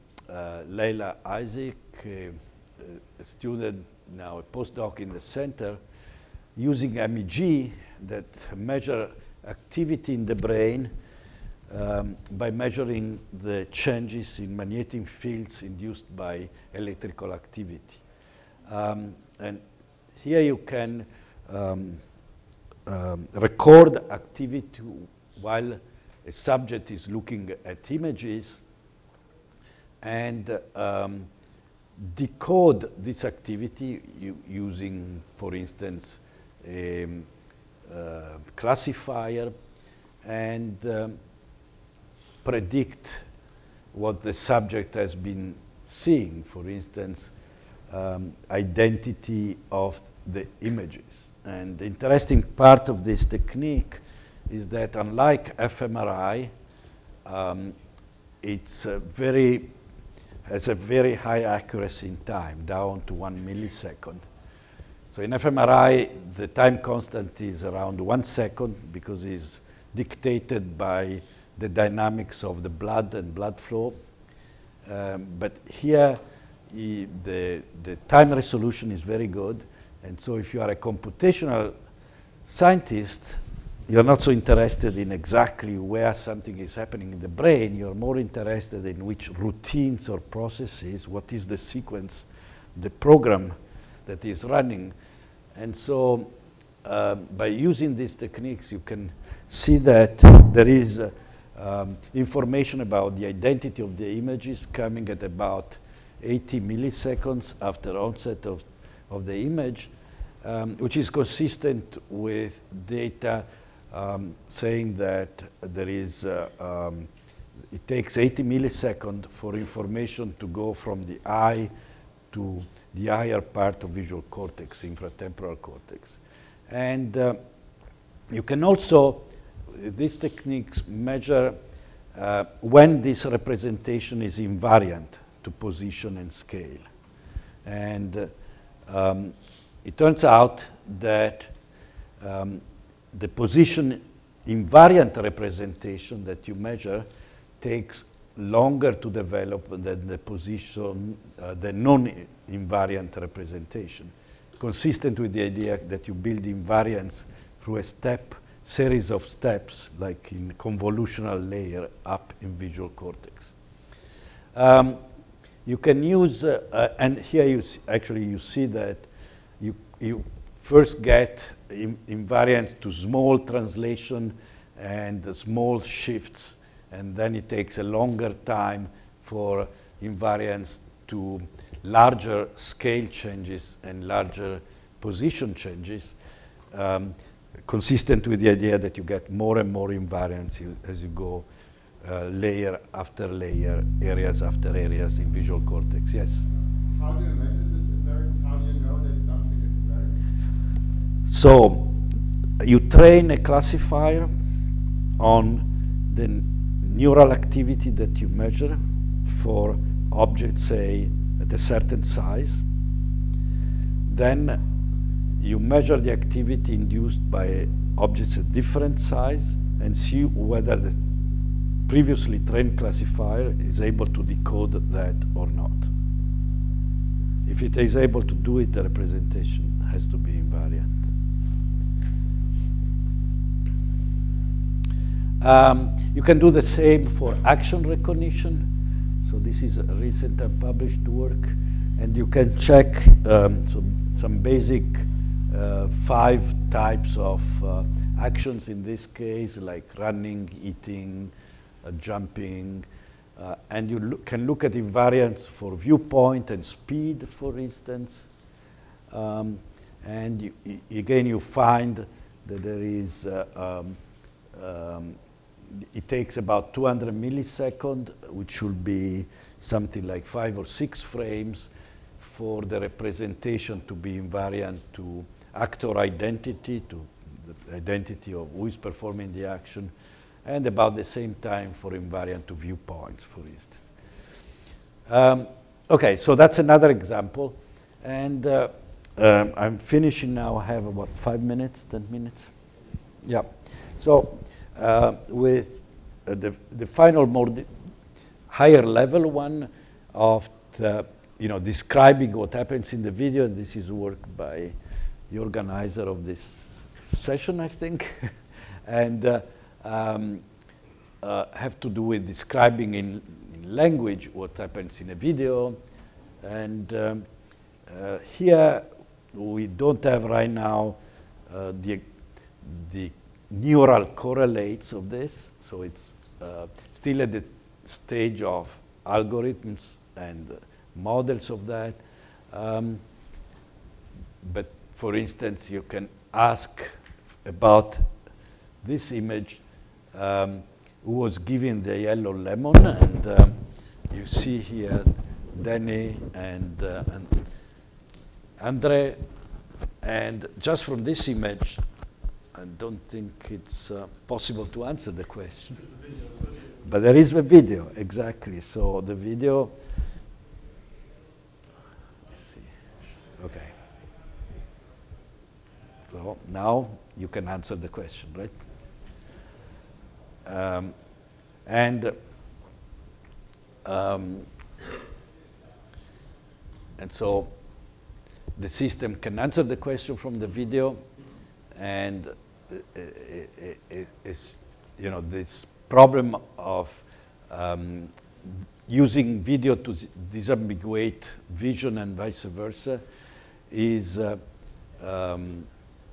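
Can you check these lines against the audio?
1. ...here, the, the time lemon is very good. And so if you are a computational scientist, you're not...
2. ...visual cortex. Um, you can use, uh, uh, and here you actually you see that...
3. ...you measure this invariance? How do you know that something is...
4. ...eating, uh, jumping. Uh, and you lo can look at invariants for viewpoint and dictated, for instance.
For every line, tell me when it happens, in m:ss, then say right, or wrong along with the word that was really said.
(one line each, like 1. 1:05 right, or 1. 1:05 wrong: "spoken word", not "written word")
1. 1:15 wrong: "resolution", not "lemon"
2. 2:42 right
3. 3:17 right
4. 4:10 wrong: "speed", not "dictated".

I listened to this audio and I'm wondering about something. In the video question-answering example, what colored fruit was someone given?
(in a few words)
Yellow lemon.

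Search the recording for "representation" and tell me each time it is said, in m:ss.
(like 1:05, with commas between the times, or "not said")
2:13, 2:25, 2:33, 3:48, 4:32.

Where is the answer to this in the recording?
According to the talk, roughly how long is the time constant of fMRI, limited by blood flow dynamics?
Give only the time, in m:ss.
1:08.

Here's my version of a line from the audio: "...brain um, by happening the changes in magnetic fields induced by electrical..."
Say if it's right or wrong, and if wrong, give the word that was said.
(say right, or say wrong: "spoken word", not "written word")
wrong: "measuring", not "happening".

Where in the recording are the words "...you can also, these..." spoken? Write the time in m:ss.
2:08.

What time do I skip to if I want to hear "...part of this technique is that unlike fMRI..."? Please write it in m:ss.
0:52.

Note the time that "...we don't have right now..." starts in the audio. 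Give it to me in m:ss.
5:19.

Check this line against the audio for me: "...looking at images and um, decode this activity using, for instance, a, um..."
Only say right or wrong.
right.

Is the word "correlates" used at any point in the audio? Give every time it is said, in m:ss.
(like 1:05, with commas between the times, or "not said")
5:24.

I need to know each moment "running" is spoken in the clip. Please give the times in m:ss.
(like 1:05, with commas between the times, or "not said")
1:34, 4:09.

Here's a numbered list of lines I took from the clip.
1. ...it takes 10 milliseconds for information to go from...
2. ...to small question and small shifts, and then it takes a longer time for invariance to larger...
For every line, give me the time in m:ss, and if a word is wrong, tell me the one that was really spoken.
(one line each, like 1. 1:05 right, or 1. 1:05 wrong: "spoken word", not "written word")
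1. 1:57 wrong: "80", not "10"
2. 2:52 wrong: "translation", not "question".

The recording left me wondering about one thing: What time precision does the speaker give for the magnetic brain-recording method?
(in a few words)
1 millisecond.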